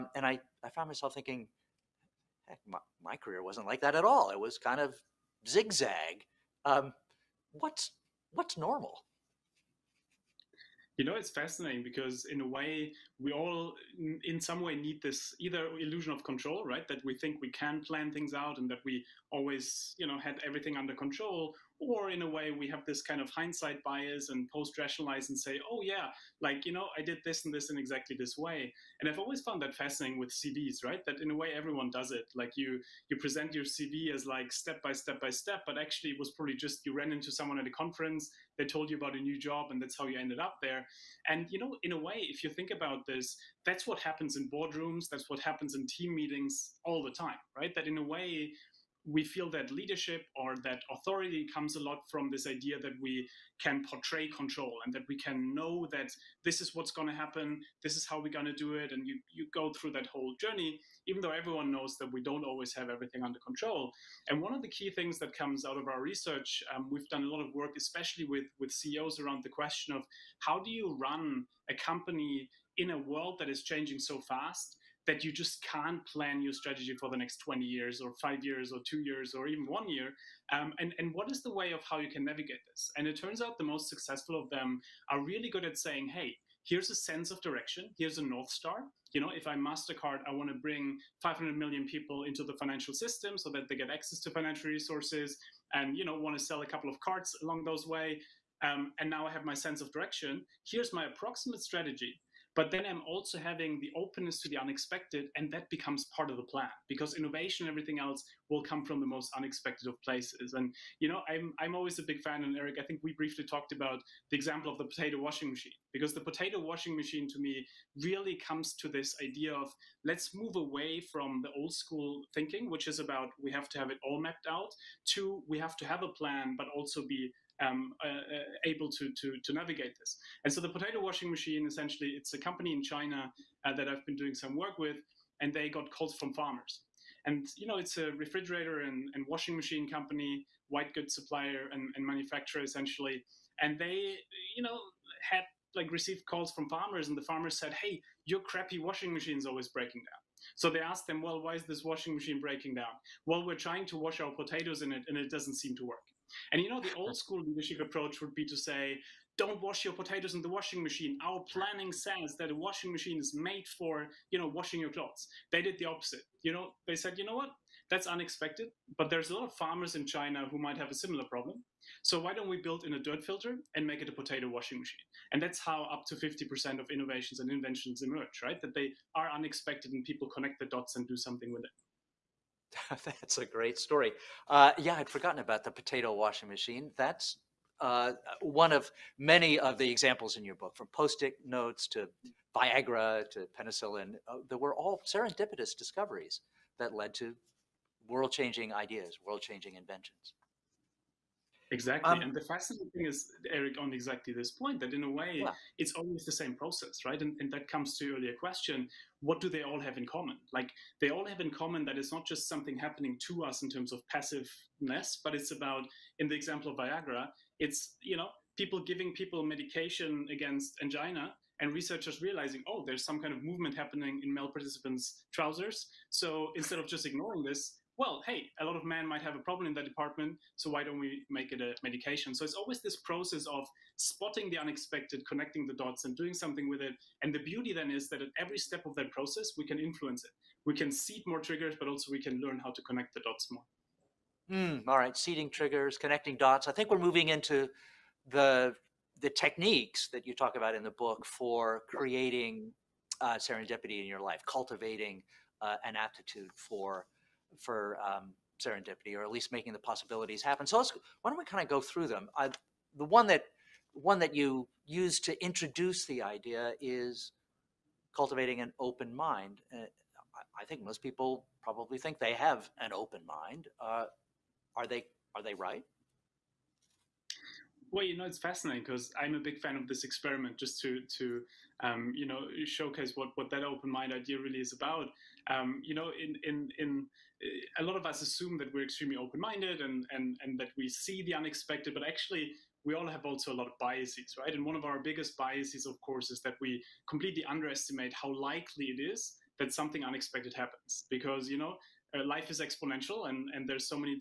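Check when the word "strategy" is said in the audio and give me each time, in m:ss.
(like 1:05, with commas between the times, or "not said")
1:16, 1:41.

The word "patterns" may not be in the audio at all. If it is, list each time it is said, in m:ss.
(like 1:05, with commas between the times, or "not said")
not said.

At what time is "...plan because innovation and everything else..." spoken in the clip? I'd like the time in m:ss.
1:46.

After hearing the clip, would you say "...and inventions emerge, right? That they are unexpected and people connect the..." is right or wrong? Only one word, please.
right.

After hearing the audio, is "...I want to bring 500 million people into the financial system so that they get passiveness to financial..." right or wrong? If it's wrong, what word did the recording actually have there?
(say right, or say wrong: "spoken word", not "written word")
wrong: "access", not "passiveness".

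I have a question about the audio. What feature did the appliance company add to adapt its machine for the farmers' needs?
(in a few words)
A dirt filter.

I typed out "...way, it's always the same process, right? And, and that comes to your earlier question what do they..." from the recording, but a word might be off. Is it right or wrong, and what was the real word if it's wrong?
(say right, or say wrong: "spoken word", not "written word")
right.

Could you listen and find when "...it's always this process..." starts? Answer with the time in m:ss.
3:52.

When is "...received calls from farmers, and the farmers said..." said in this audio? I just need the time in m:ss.
2:25.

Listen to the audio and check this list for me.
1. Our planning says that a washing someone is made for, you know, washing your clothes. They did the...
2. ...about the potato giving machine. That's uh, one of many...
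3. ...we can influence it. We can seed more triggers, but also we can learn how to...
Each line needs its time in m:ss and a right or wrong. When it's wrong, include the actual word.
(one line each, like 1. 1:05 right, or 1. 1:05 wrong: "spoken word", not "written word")
1. 2:41 wrong: "machine", not "someone"
2. 3:05 wrong: "washing", not "giving"
3. 3:59 right.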